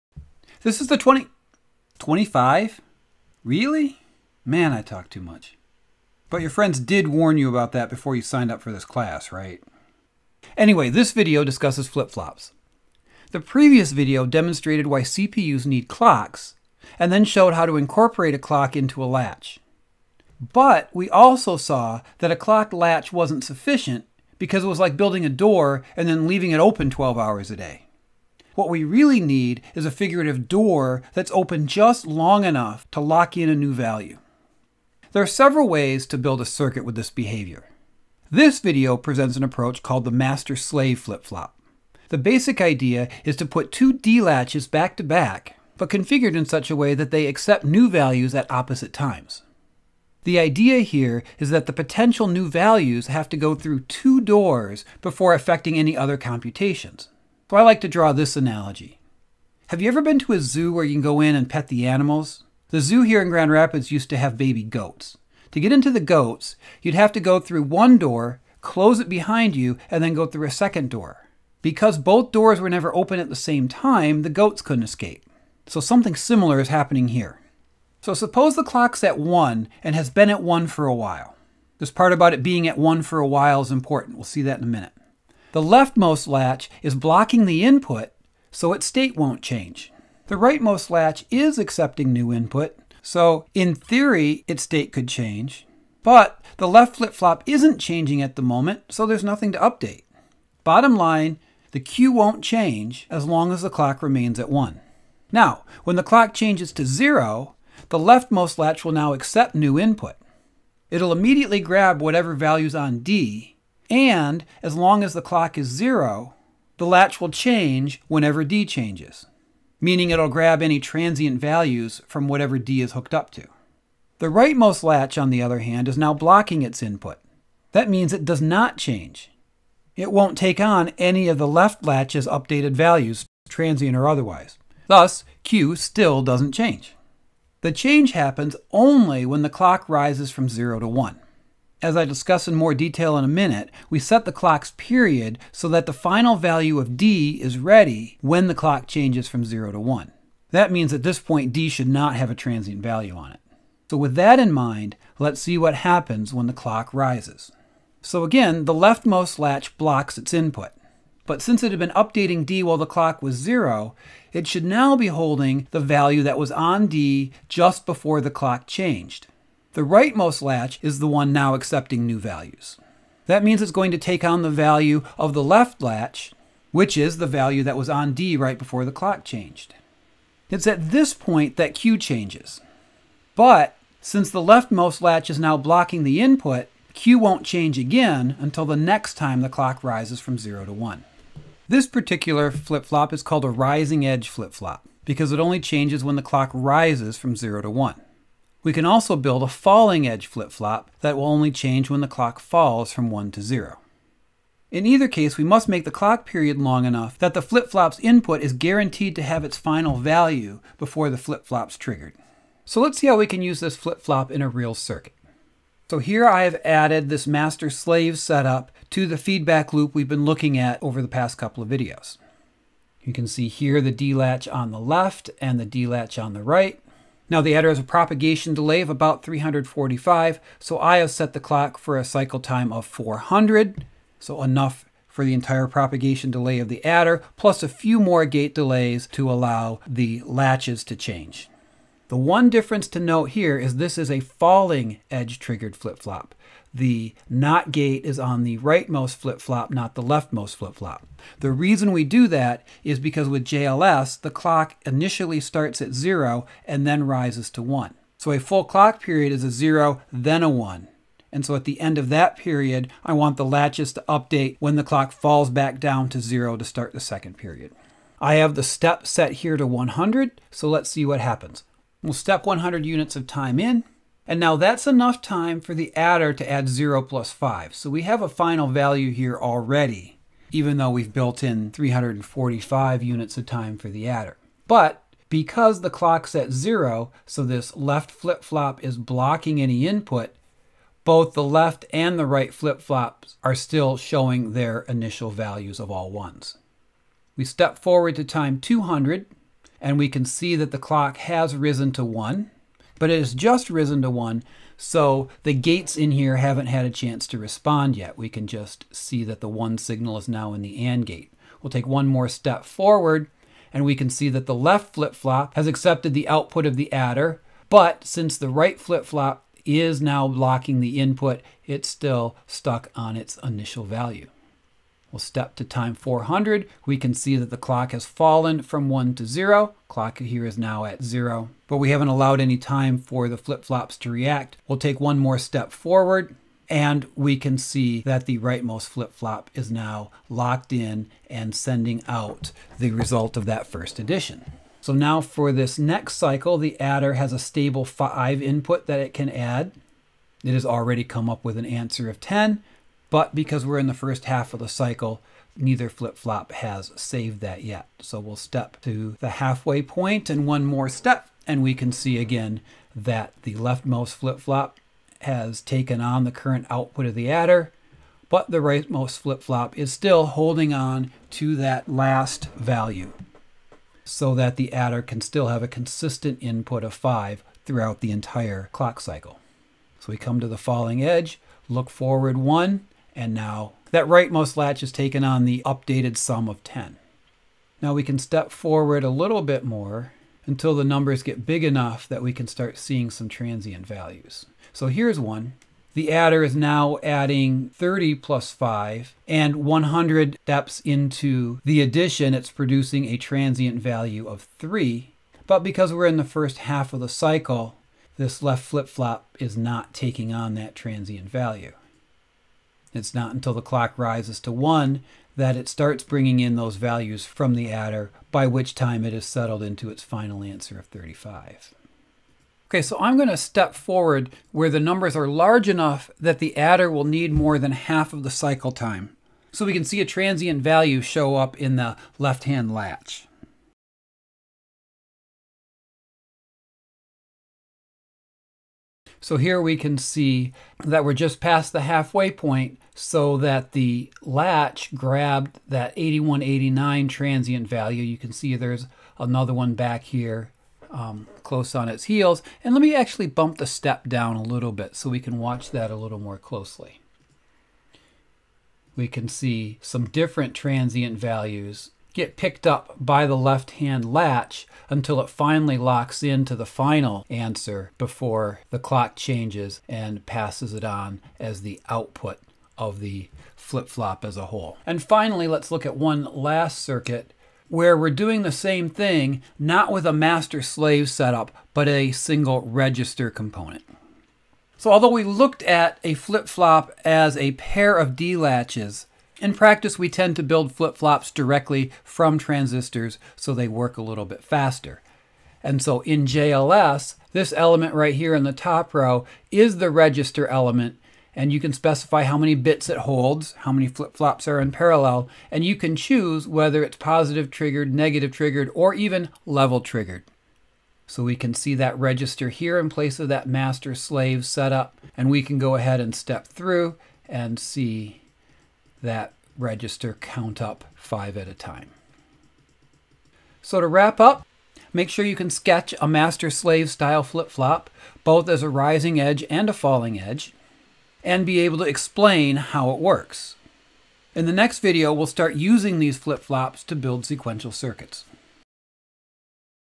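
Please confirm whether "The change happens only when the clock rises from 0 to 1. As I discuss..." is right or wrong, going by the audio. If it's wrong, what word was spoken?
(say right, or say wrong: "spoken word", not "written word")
right.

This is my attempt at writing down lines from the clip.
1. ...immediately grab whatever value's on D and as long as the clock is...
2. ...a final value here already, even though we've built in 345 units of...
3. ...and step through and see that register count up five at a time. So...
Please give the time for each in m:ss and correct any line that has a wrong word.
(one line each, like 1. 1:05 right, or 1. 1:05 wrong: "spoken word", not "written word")
1. 1:51 right
2. 4:38 right
3. 8:36 right.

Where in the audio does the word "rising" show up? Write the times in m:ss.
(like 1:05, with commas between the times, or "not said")
3:13, 8:48.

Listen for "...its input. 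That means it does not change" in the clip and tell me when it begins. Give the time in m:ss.
2:06.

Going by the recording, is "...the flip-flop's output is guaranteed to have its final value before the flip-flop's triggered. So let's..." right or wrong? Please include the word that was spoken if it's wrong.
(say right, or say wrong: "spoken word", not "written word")
wrong: "input", not "output".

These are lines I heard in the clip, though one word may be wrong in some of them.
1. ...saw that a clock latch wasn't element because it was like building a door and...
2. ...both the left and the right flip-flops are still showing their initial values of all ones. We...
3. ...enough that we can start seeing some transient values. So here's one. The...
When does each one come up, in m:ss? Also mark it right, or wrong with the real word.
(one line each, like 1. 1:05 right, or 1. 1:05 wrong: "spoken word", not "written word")
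1. 0:21 wrong: "sufficient", not "element"
2. 4:51 right
3. 6:31 right.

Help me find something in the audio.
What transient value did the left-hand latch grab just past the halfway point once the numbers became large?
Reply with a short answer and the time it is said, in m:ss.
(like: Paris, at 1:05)
8189, at 7:25.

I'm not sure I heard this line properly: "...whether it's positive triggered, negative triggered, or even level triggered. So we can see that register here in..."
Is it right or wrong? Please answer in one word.
right.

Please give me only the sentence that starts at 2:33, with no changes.
So with that in mind, let's see what happens when the clock rises.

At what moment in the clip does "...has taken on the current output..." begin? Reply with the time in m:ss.
6:05.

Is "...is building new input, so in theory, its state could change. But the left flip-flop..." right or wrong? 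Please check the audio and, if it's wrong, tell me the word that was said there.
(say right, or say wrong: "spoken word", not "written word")
wrong: "accepting", not "building".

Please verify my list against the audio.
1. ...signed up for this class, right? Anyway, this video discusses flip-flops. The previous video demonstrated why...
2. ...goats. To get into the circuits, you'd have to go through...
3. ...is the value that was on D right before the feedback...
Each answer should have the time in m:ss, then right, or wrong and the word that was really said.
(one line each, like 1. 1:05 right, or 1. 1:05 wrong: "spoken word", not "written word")
1. 0:08 right
2. 1:04 wrong: "goats", not "circuits"
3. 2:56 wrong: "clock", not "feedback".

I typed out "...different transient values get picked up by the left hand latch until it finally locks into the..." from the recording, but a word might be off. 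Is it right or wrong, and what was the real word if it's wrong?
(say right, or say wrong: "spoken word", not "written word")
right.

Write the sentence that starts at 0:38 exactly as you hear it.
This video presents an approach called the master-slave flip-flop.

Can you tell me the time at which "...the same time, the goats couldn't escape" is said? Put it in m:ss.
1:13.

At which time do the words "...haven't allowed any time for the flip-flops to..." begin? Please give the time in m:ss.
5:31.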